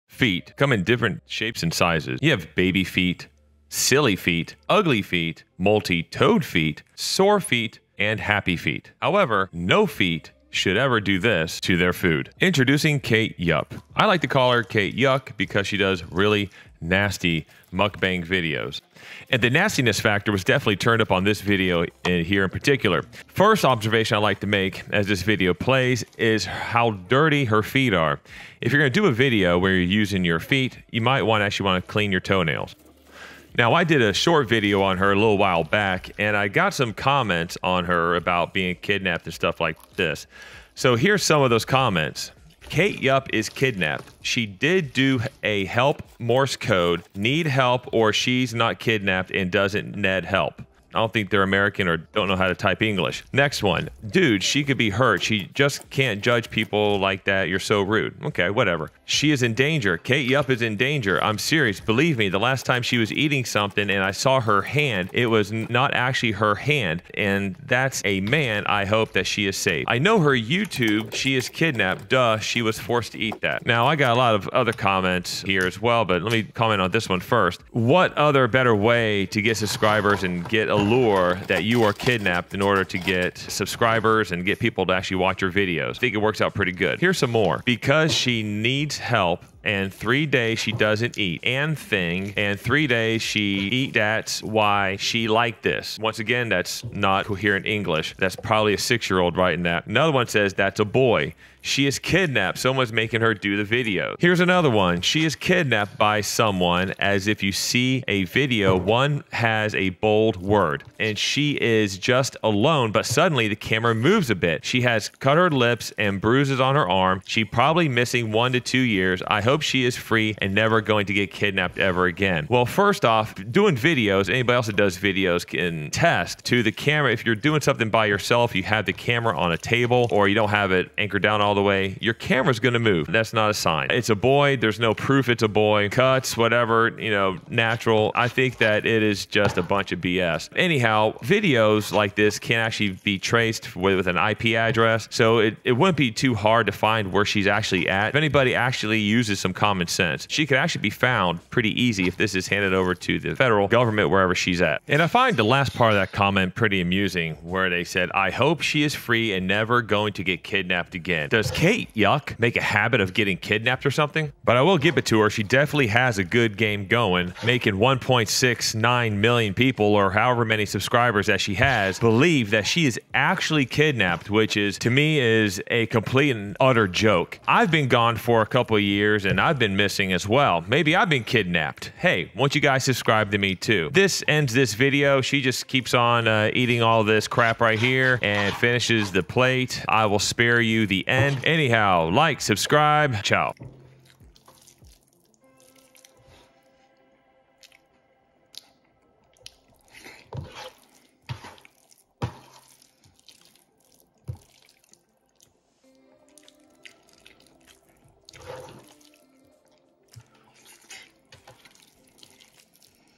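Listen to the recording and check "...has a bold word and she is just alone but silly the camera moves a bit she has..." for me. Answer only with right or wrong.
wrong.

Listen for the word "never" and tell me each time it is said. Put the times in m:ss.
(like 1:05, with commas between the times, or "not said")
2:00, 2:39.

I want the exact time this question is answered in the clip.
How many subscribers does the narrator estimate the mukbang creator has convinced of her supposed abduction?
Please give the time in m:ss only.
2:47.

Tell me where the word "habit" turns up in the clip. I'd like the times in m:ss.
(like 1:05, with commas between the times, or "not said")
2:42.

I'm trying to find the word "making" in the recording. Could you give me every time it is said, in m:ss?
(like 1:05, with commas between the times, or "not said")
1:42, 2:47.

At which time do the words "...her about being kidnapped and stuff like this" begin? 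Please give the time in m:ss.
0:37.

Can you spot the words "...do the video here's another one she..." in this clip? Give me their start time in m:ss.
1:43.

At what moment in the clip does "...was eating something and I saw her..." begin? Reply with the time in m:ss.
1:02.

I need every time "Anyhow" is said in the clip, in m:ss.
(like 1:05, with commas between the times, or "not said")
2:20, 3:11.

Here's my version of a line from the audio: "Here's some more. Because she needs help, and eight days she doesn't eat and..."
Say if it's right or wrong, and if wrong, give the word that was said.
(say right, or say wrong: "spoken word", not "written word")
wrong: "three", not "eight".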